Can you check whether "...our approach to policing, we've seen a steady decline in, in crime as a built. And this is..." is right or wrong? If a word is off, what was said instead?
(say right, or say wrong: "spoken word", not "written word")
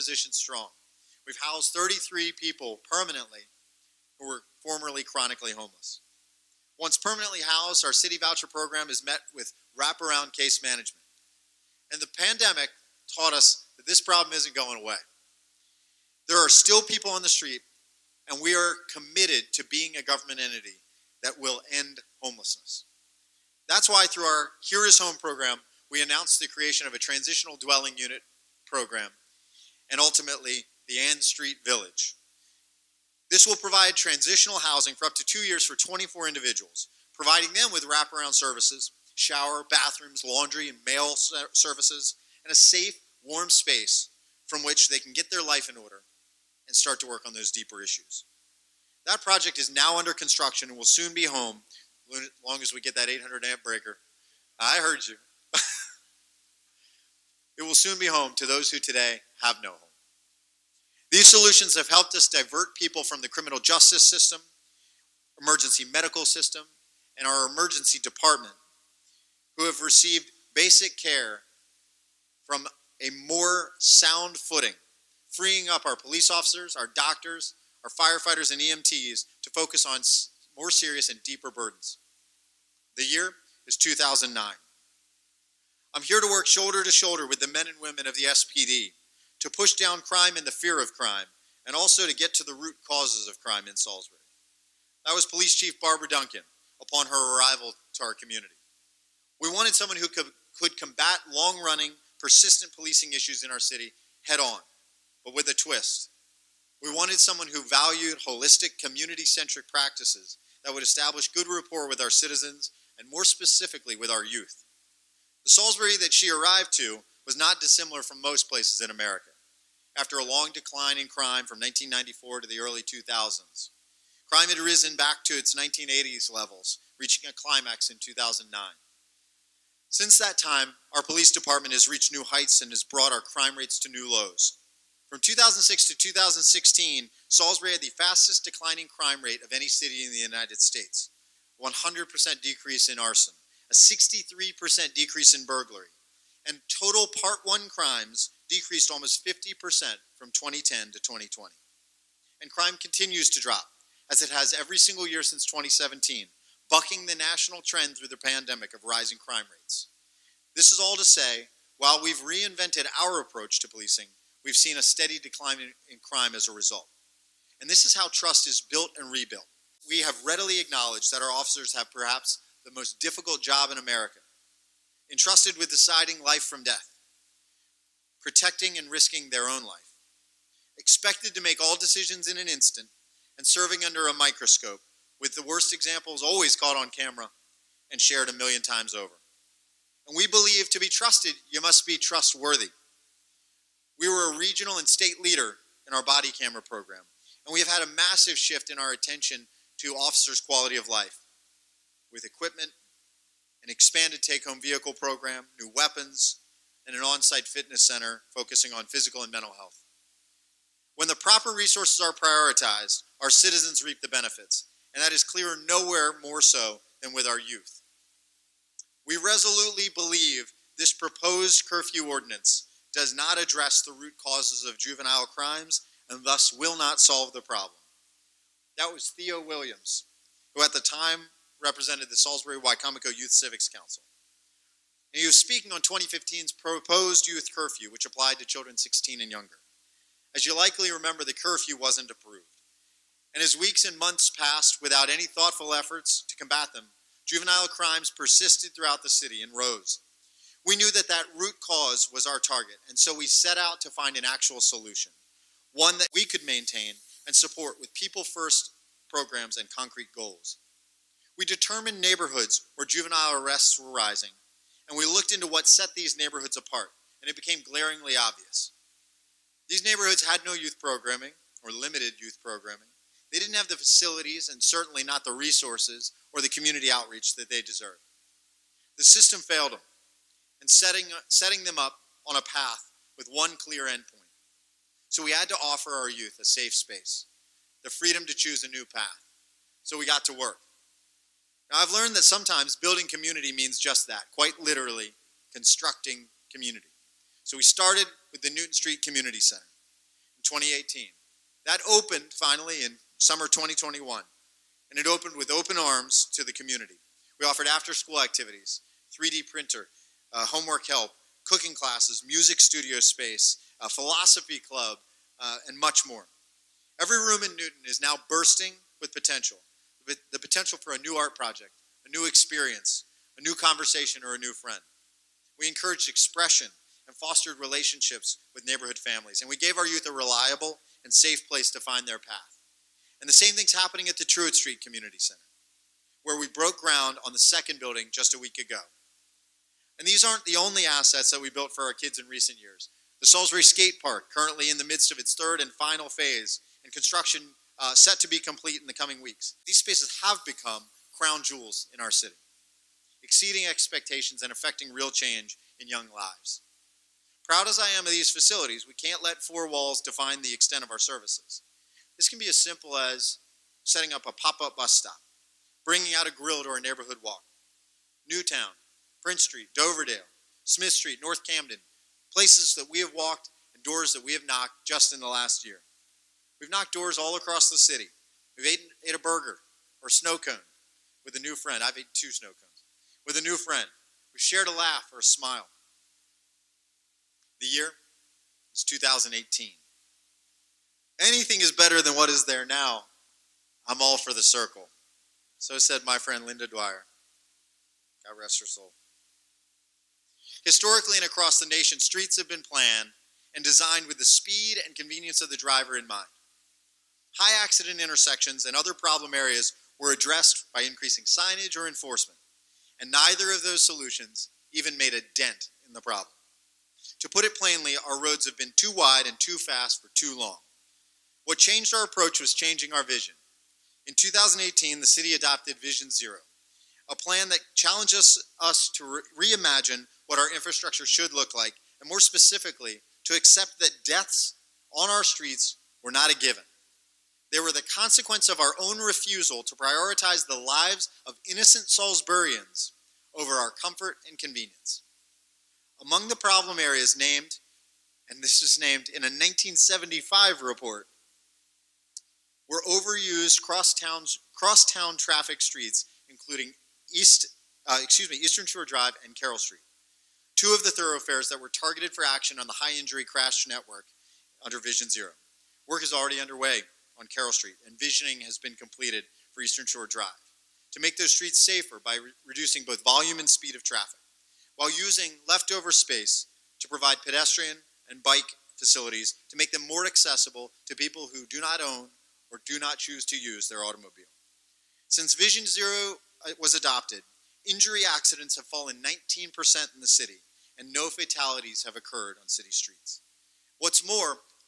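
wrong: "result", not "built".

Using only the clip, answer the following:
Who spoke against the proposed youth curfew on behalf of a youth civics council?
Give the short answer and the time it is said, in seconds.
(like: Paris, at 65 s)
Theo Williams, at 229 s.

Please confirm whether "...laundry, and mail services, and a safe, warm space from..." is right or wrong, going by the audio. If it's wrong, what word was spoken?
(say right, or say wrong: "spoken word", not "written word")
right.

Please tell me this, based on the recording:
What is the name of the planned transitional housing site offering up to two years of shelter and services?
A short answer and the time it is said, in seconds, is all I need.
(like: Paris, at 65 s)
Ann Street Village, at 30 s.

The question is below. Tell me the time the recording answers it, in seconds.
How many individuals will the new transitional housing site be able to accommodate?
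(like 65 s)
35 s.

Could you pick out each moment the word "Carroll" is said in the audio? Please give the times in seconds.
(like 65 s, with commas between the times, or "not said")
459 s, 467 s.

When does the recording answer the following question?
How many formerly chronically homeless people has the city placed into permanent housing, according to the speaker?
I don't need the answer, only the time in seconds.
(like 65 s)
1 s.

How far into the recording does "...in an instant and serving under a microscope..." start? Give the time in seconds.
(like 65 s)
182 s.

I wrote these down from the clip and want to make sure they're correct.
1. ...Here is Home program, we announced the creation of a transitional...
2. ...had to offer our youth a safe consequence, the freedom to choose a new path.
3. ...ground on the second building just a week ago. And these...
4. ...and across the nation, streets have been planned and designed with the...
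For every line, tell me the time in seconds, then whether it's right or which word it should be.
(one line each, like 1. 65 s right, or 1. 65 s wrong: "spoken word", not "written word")
1. 24 s right
2. 285 s wrong: "space", not "consequence"
3. 336 s right
4. 401 s right.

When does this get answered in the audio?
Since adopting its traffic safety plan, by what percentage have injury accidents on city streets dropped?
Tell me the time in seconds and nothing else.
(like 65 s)
489 s.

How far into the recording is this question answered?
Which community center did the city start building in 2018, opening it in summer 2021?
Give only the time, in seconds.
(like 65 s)
298 s.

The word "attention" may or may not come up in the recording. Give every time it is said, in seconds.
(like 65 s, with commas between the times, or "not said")
198 s.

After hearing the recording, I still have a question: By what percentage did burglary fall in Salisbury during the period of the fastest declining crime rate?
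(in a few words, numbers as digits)
63%.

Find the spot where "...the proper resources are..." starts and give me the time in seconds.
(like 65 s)
211 s.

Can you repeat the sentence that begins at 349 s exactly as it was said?
These spaces have become crown jewels in our city, exceeding expectations and affecting real change in young lives.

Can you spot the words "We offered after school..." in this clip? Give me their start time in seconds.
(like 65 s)
307 s.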